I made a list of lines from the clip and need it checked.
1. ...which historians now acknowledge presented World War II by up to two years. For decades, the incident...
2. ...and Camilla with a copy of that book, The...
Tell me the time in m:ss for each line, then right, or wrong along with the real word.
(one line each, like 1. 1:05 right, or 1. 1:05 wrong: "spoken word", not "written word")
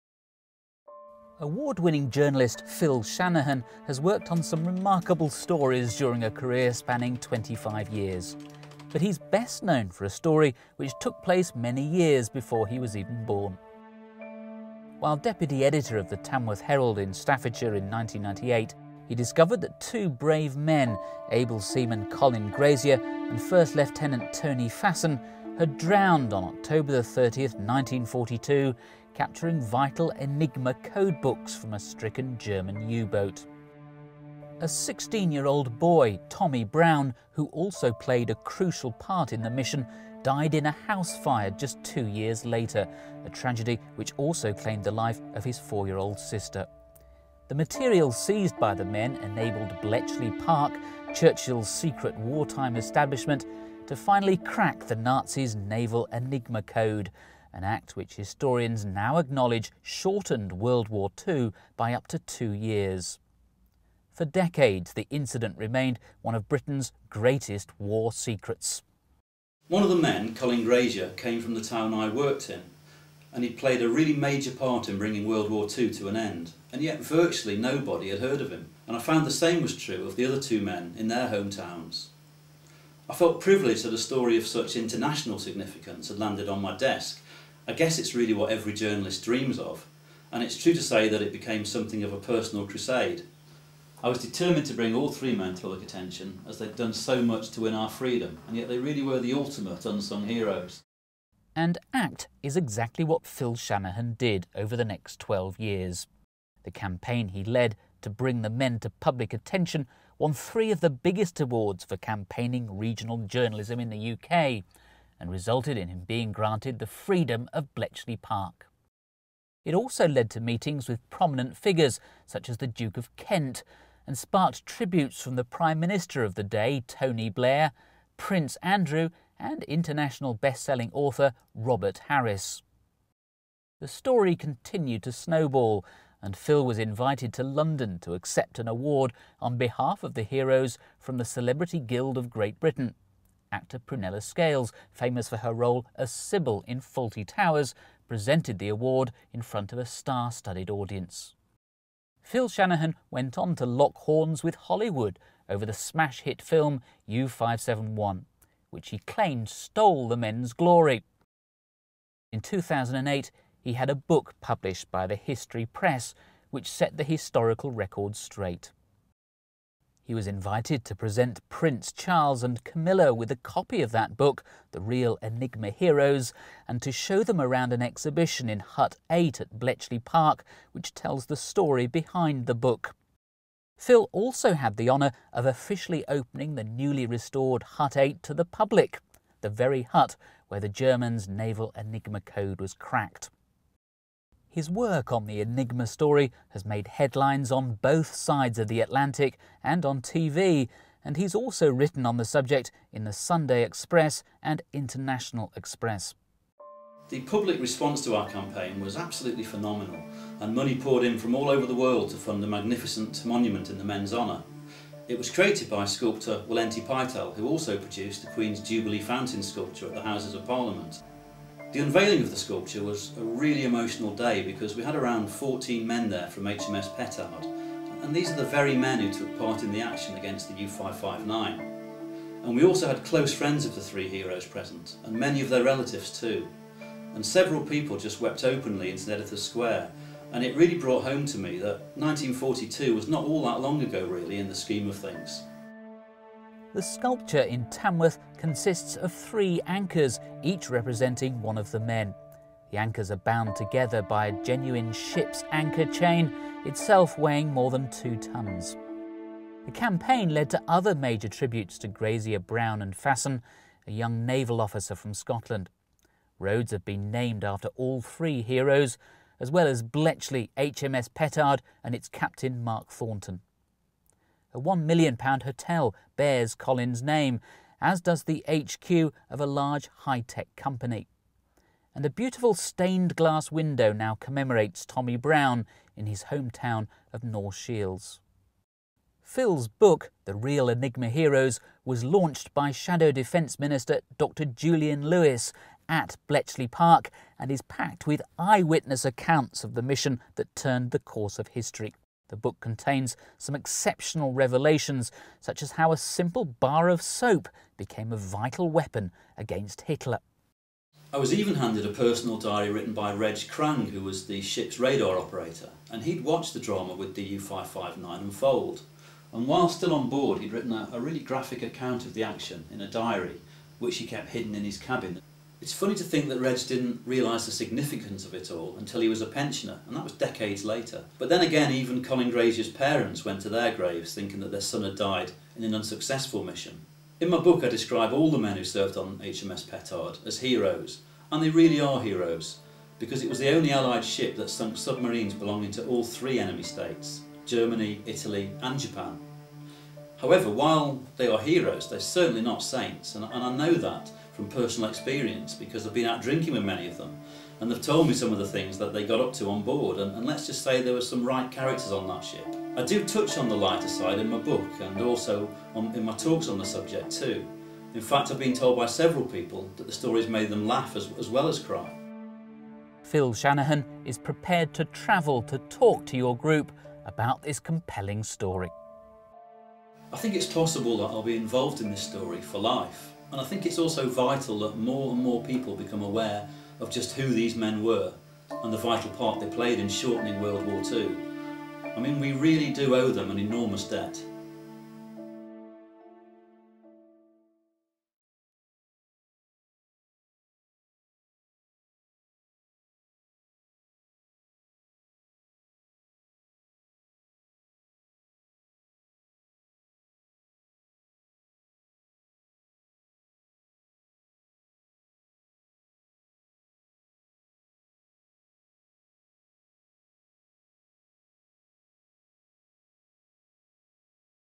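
1. 0:57 wrong: "shortened", not "presented"
2. 2:52 right.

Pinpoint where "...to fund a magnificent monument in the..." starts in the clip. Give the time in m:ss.
3:32.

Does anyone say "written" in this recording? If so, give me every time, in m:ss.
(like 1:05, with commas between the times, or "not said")
3:21, 5:12, 5:20.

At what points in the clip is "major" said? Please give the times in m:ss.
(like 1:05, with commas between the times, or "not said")
1:14, 4:20.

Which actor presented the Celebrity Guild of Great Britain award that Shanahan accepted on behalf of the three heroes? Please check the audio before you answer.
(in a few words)
Prunella Scales.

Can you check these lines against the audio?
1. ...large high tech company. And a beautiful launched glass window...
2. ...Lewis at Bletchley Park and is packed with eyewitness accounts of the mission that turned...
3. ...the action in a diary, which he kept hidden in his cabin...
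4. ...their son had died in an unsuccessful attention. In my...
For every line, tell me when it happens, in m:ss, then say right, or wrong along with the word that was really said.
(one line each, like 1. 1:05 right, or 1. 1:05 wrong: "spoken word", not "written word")
1. 4:39 wrong: "stained", not "launched"
2. 4:55 right
3. 5:22 right
4. 5:34 wrong: "mission", not "attention".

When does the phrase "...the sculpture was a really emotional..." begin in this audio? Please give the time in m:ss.
3:42.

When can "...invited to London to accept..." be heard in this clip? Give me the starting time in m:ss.
2:16.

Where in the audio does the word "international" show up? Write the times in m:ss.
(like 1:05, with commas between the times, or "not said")
1:24, 2:09, 3:24.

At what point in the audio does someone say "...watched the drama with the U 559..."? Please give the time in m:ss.
5:16.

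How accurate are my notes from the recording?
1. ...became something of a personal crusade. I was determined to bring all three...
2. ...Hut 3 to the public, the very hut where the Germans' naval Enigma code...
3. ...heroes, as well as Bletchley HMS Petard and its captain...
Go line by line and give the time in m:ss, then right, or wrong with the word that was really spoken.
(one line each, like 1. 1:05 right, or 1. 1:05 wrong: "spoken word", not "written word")
1. 1:31 right
2. 3:07 wrong: "8", not "3"
3. 4:28 right.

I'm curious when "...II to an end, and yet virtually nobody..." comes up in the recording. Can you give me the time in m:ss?
1:15.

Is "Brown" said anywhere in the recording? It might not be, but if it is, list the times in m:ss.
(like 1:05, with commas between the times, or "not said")
0:36, 4:22, 4:45.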